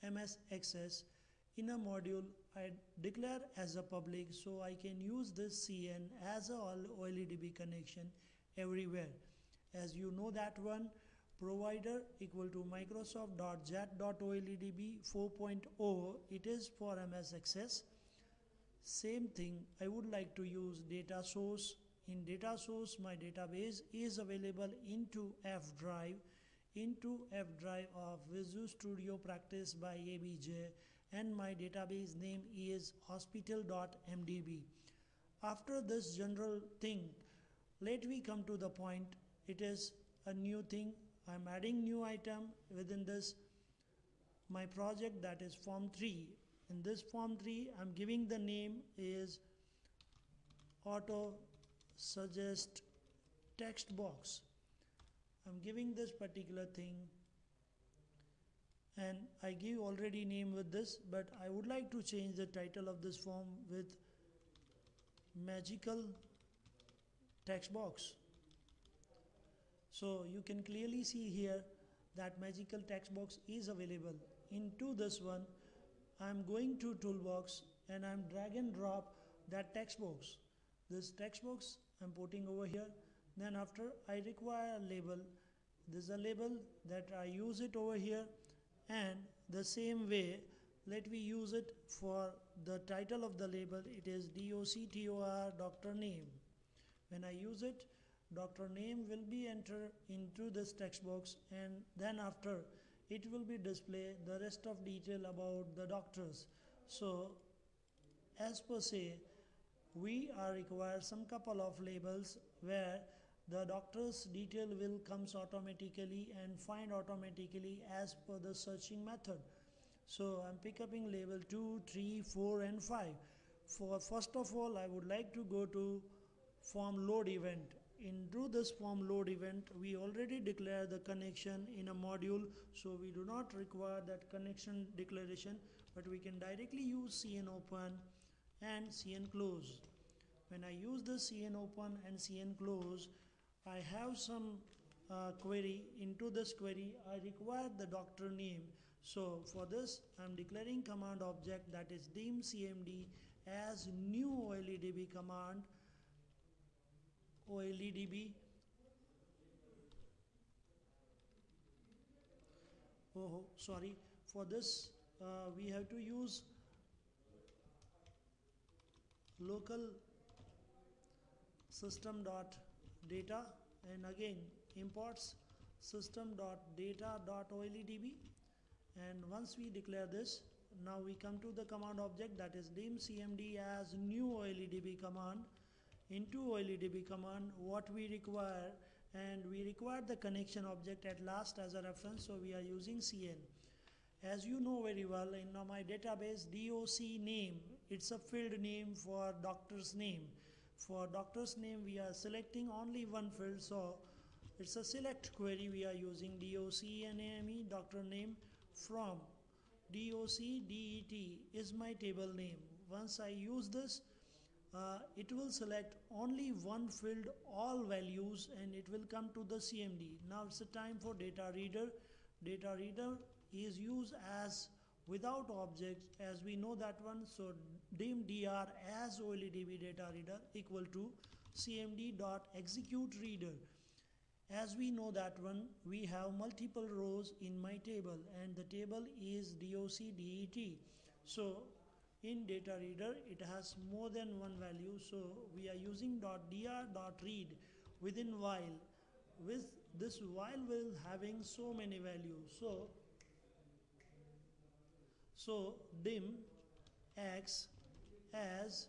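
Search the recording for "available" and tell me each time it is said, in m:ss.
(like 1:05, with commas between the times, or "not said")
0:24, 1:13.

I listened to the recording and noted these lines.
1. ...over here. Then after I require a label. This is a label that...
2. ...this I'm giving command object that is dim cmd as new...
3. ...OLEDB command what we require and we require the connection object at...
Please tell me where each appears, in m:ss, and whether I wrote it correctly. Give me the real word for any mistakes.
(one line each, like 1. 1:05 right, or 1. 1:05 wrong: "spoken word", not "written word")
1. 1:22 right
2. 2:29 wrong: "declaring", not "giving"
3. 3:06 right.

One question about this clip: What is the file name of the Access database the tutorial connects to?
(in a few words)
hospital.mdb.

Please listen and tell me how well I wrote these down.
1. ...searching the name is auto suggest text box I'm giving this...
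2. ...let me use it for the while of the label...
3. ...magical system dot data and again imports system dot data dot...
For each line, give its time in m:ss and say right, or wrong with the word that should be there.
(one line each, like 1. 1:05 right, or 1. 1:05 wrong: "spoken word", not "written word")
1. 0:47 wrong: "giving", not "searching"
2. 1:30 wrong: "title", not "while"
3. 2:49 wrong: "local", not "magical".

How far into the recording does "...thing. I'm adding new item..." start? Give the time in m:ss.
0:40.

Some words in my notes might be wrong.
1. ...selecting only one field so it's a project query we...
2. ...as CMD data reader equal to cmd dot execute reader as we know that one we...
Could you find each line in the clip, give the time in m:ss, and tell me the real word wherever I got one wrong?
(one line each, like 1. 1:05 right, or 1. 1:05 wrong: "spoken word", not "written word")
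1. 3:22 wrong: "select", not "project"
2. 3:49 wrong: "OLEDB", not "CMD".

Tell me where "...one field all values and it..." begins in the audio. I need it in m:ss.
3:36.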